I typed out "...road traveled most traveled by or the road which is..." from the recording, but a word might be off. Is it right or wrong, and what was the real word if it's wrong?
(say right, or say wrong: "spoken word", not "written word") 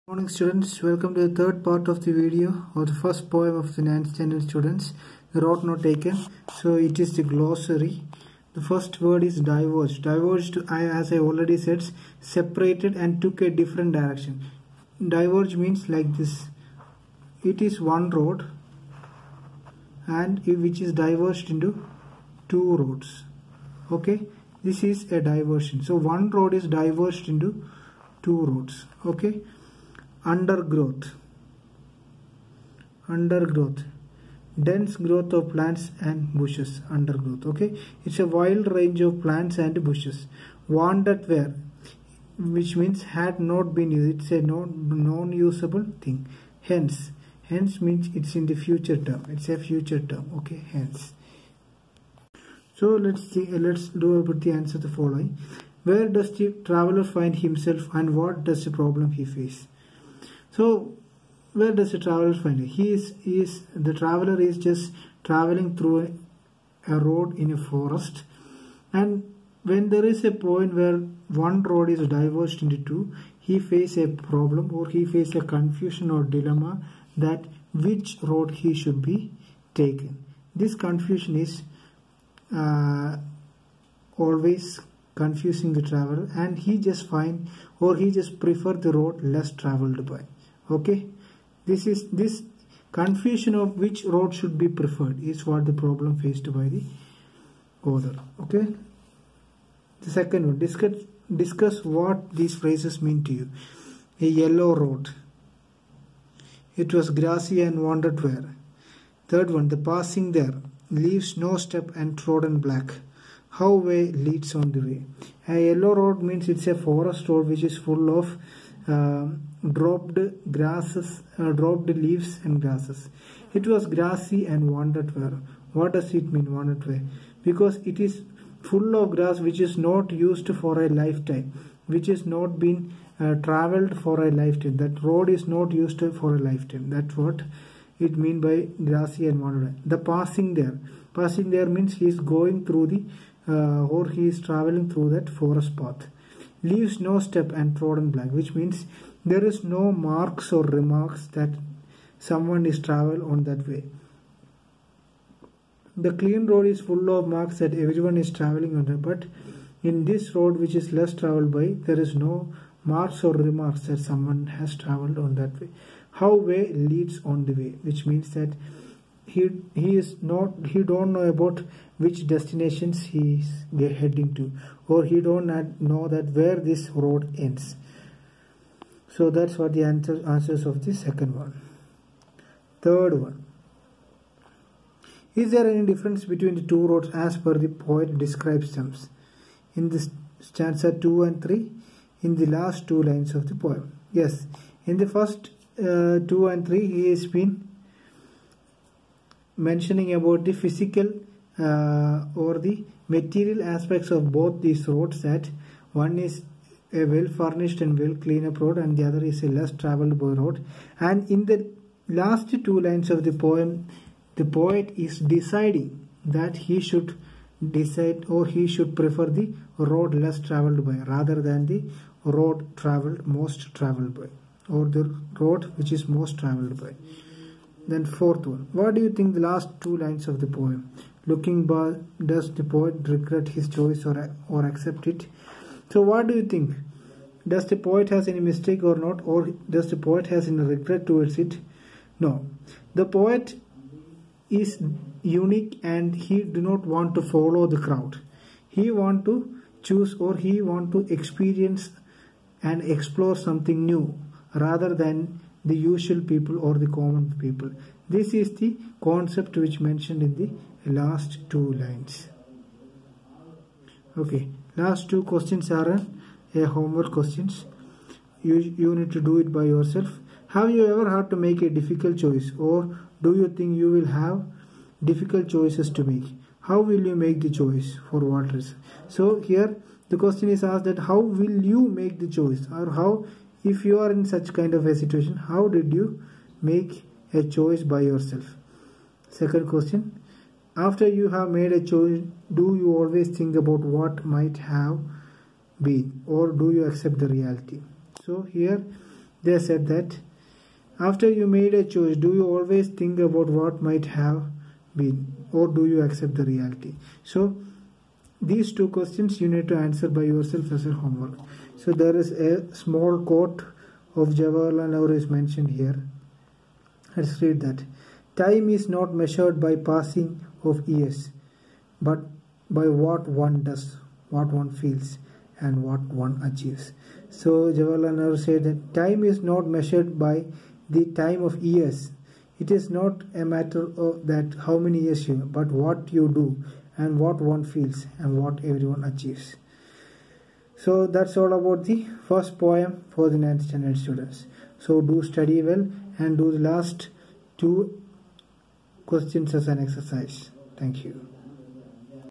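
right.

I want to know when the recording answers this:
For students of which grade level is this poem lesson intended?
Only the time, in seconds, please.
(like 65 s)
3 s.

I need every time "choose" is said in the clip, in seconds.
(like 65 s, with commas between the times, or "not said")
249 s.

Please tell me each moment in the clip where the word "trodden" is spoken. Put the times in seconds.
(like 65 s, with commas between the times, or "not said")
112 s, 147 s.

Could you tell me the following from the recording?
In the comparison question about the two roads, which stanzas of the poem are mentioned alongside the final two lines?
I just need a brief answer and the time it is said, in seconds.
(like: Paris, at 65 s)
Stanzas 2 and 3, at 190 s.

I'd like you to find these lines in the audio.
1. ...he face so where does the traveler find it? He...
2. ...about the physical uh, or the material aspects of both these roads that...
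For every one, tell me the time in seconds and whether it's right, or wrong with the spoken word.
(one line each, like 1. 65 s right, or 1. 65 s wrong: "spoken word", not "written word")
1. 59 s right
2. 200 s right.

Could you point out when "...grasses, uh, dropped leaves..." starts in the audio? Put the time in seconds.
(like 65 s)
120 s.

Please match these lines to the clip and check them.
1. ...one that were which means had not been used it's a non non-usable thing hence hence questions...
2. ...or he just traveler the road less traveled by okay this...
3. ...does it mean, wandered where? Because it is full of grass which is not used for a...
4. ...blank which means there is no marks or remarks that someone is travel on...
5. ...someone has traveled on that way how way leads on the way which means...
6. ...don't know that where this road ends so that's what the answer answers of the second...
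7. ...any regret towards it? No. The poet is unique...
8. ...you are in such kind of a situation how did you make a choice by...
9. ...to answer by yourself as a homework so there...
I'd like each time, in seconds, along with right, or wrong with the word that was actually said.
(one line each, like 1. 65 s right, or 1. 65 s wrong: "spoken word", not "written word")
1. 40 s wrong: "means", not "questions"
2. 87 s wrong: "prefer", not "traveler"
3. 125 s right
4. 148 s right
5. 163 s right
6. 175 s right
7. 240 s right
8. 283 s right
9. 309 s right.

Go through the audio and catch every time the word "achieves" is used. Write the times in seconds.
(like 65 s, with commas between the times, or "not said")
326 s, 339 s.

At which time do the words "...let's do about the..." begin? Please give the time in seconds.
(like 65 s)
53 s.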